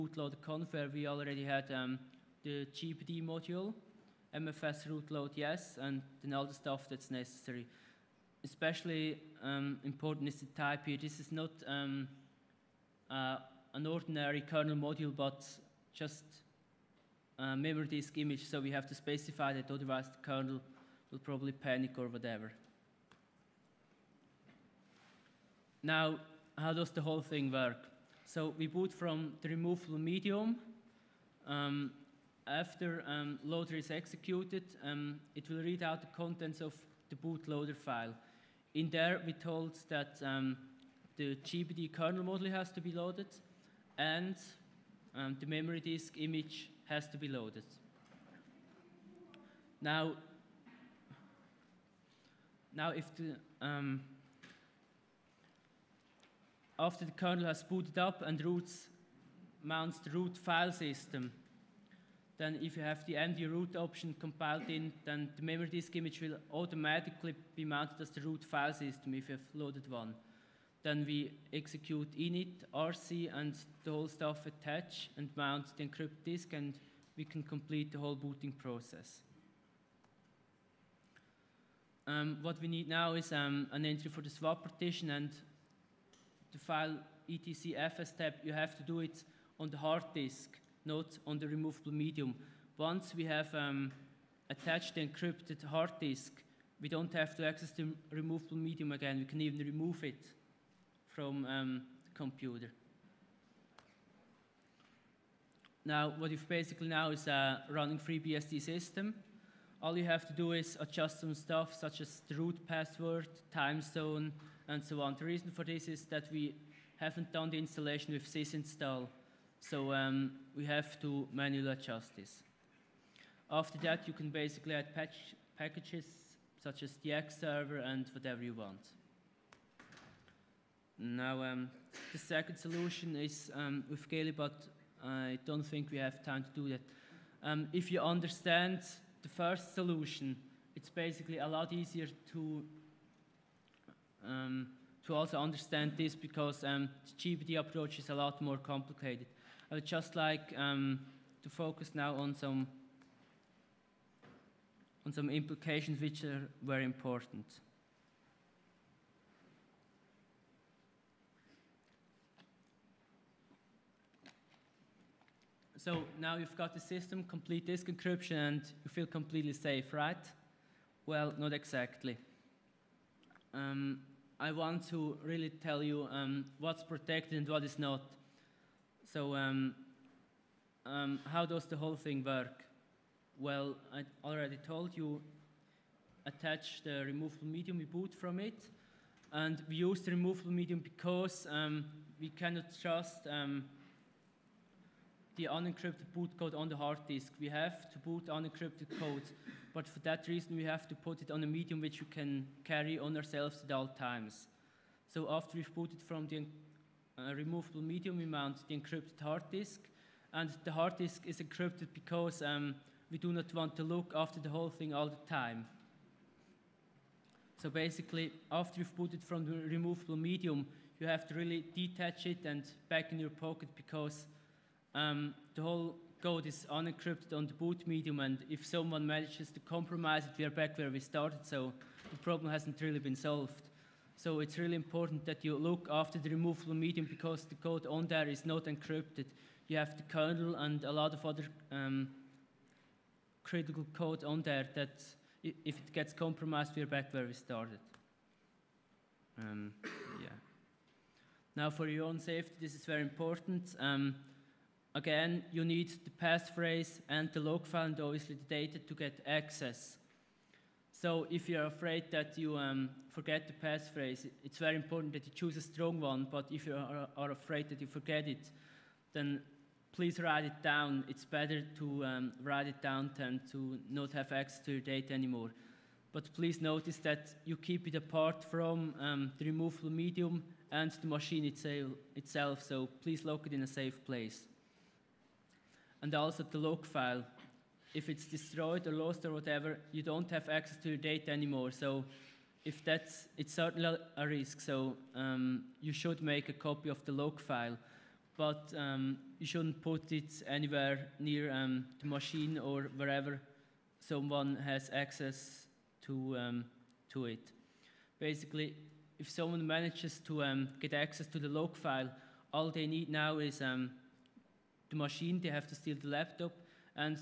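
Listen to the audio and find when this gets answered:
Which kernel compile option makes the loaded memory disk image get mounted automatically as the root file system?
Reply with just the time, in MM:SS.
01:03.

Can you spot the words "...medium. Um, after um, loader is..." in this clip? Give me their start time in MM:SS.
00:29.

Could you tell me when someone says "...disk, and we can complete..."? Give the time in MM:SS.
01:16.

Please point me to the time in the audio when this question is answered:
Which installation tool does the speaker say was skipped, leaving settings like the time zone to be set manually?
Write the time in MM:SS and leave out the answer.
01:58.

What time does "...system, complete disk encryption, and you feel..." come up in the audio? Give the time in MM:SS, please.
02:46.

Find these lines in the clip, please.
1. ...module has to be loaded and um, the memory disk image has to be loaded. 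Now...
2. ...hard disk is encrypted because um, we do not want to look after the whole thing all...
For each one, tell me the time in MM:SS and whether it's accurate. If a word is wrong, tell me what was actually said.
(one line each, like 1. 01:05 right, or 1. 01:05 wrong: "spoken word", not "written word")
1. 00:42 right
2. 03:30 right.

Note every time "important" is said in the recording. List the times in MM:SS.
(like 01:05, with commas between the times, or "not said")
00:09, 02:36, 03:54, 04:13, 04:24.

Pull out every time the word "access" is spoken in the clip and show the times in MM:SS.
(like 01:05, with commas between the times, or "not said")
01:37, 04:19, 04:34, 04:50, 05:04, 05:10.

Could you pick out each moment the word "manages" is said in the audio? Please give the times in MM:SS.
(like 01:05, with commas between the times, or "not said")
03:49, 05:09.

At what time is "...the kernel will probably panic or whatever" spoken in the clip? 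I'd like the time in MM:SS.
00:20.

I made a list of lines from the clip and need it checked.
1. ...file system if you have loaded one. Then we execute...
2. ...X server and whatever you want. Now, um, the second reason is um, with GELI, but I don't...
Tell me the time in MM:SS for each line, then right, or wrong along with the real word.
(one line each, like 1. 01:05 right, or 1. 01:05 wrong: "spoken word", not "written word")
1. 01:08 right
2. 02:07 wrong: "solution", not "reason".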